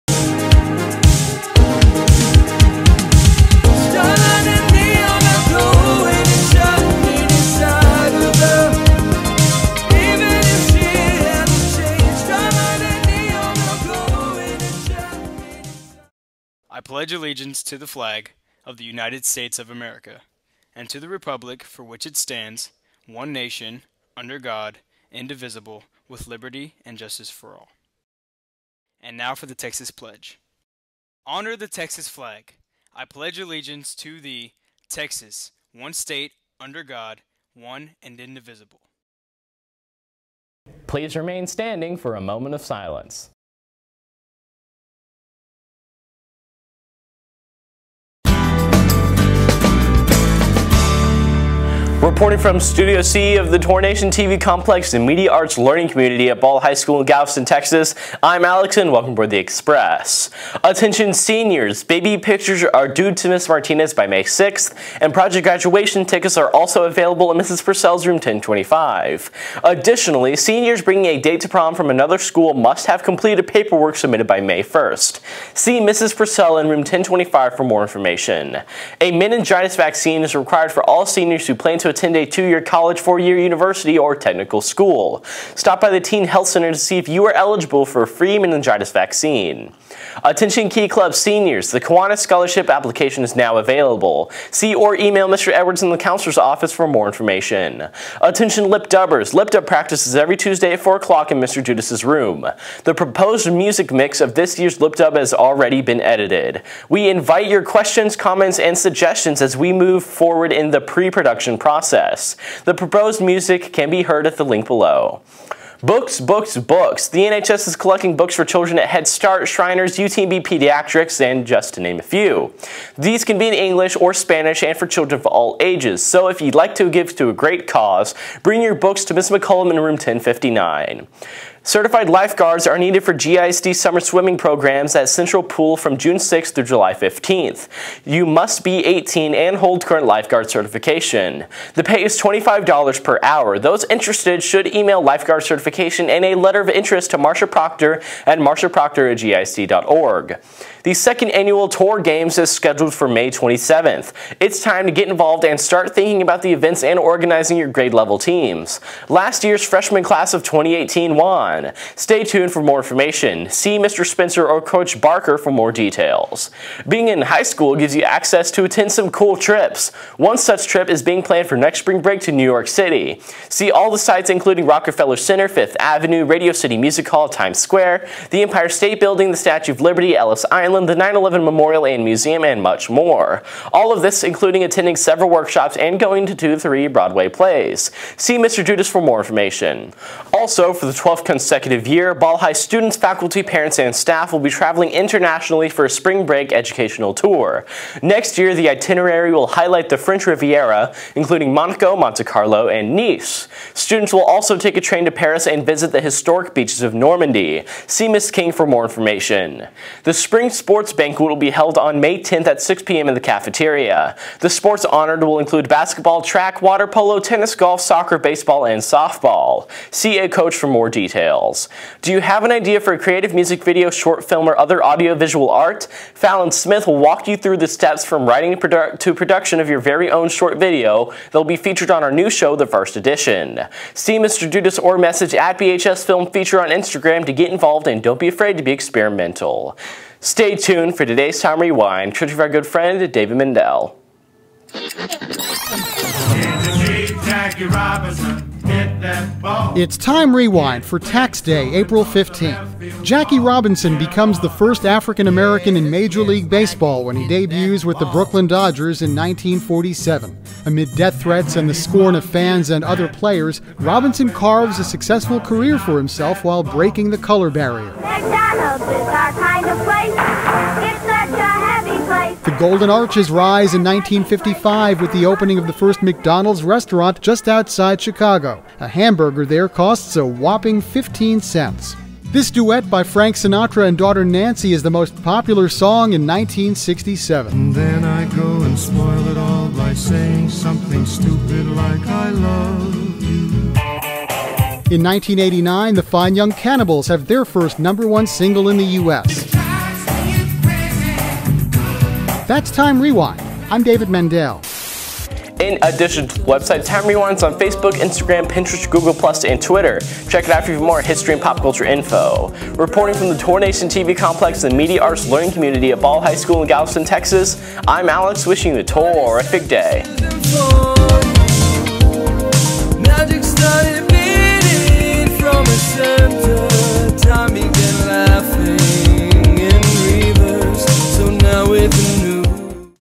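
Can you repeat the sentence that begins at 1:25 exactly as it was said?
Stop by the Teen Health Center to see if you are eligible for a free meningitis vaccine.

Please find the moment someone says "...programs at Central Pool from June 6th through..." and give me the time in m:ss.
2:14.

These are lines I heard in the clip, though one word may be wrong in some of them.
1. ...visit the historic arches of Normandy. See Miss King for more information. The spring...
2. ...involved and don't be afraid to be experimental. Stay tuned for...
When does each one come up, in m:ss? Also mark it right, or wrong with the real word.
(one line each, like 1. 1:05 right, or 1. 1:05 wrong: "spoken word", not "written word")
1. 3:25 wrong: "beaches", not "arches"
2. 3:57 right.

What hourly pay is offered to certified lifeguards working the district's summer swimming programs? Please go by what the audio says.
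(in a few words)
$25.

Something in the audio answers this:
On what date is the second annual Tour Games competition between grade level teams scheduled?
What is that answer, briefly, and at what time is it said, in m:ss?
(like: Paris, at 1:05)
May 27th, at 2:33.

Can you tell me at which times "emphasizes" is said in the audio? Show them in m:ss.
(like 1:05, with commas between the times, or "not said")
not said.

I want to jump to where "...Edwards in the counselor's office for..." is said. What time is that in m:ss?
1:35.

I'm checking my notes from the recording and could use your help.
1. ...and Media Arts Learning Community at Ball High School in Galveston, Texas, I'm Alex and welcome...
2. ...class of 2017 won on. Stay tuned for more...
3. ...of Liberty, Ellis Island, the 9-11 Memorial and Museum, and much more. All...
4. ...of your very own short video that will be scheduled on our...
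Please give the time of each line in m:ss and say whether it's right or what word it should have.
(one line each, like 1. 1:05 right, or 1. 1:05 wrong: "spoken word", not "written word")
1. 0:54 right
2. 2:40 wrong: "2018", not "2017"
3. 2:59 right
4. 3:49 wrong: "featured", not "scheduled".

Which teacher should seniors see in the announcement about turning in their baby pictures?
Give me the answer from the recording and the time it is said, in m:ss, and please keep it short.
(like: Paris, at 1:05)
Ms. Martinez, at 1:03.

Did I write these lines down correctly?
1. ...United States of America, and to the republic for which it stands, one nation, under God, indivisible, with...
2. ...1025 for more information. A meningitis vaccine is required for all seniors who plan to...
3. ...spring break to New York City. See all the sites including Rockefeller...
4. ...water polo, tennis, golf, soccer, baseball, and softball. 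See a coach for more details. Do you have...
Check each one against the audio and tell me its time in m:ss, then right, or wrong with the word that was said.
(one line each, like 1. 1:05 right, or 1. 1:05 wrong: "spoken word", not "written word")
1. 0:18 right
2. 1:16 right
3. 2:51 right
4. 3:36 right.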